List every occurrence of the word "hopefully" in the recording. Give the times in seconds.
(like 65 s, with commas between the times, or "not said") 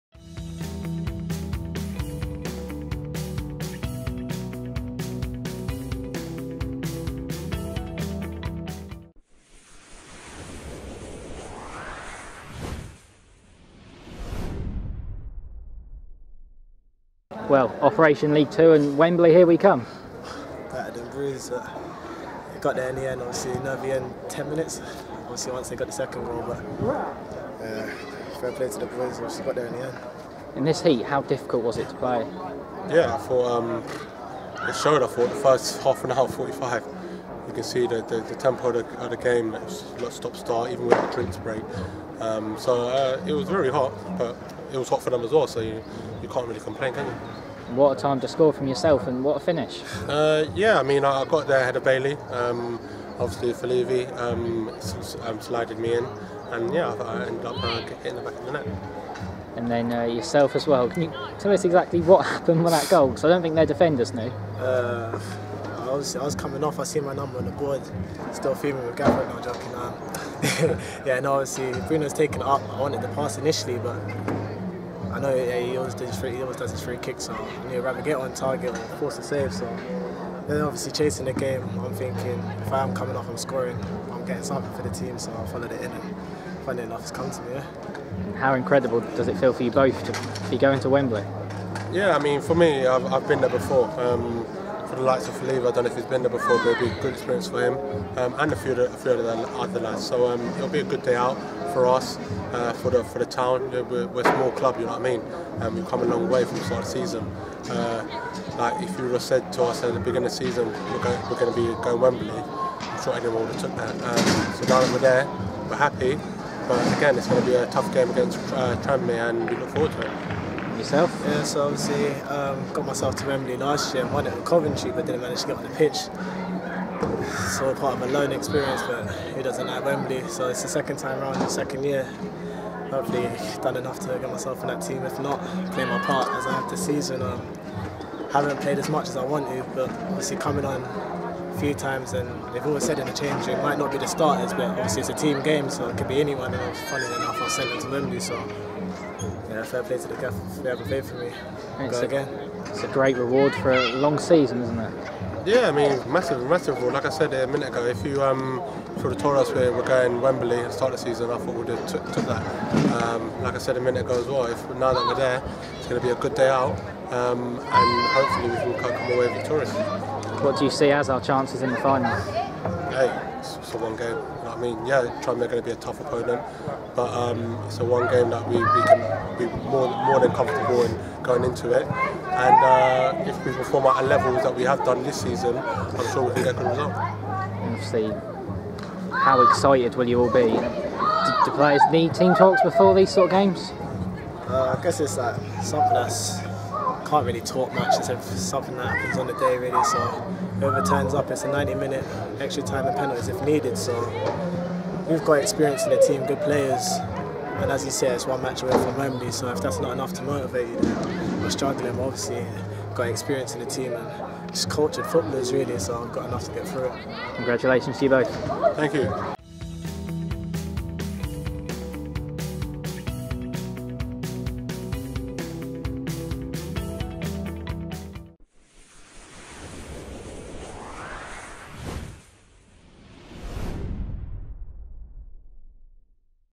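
132 s, 168 s.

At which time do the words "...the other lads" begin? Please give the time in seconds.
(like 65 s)
99 s.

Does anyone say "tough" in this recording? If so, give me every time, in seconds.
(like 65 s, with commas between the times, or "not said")
117 s, 175 s.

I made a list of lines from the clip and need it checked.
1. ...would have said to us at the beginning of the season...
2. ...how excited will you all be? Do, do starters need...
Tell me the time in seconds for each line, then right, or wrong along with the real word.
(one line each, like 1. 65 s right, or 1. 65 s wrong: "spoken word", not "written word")
1. 109 s right
2. 189 s wrong: "players", not "starters".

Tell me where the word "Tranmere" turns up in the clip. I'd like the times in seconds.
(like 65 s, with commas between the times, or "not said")
118 s, 175 s.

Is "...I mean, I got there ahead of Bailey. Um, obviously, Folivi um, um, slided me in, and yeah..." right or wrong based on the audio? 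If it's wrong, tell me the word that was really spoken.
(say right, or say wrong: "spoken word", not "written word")
right.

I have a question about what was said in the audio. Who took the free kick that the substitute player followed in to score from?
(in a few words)
Bruno.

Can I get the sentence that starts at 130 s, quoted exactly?
So it's the second time around, the second year.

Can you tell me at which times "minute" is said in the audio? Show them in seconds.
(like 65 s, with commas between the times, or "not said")
24 s, 157 s, 163 s, 201 s.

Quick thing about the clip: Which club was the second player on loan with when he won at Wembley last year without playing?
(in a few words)
Coventry.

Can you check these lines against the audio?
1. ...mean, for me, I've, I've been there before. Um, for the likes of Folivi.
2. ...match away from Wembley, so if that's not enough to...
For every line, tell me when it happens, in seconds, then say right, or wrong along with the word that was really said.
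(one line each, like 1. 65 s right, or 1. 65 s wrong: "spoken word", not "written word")
1. 92 s right
2. 208 s right.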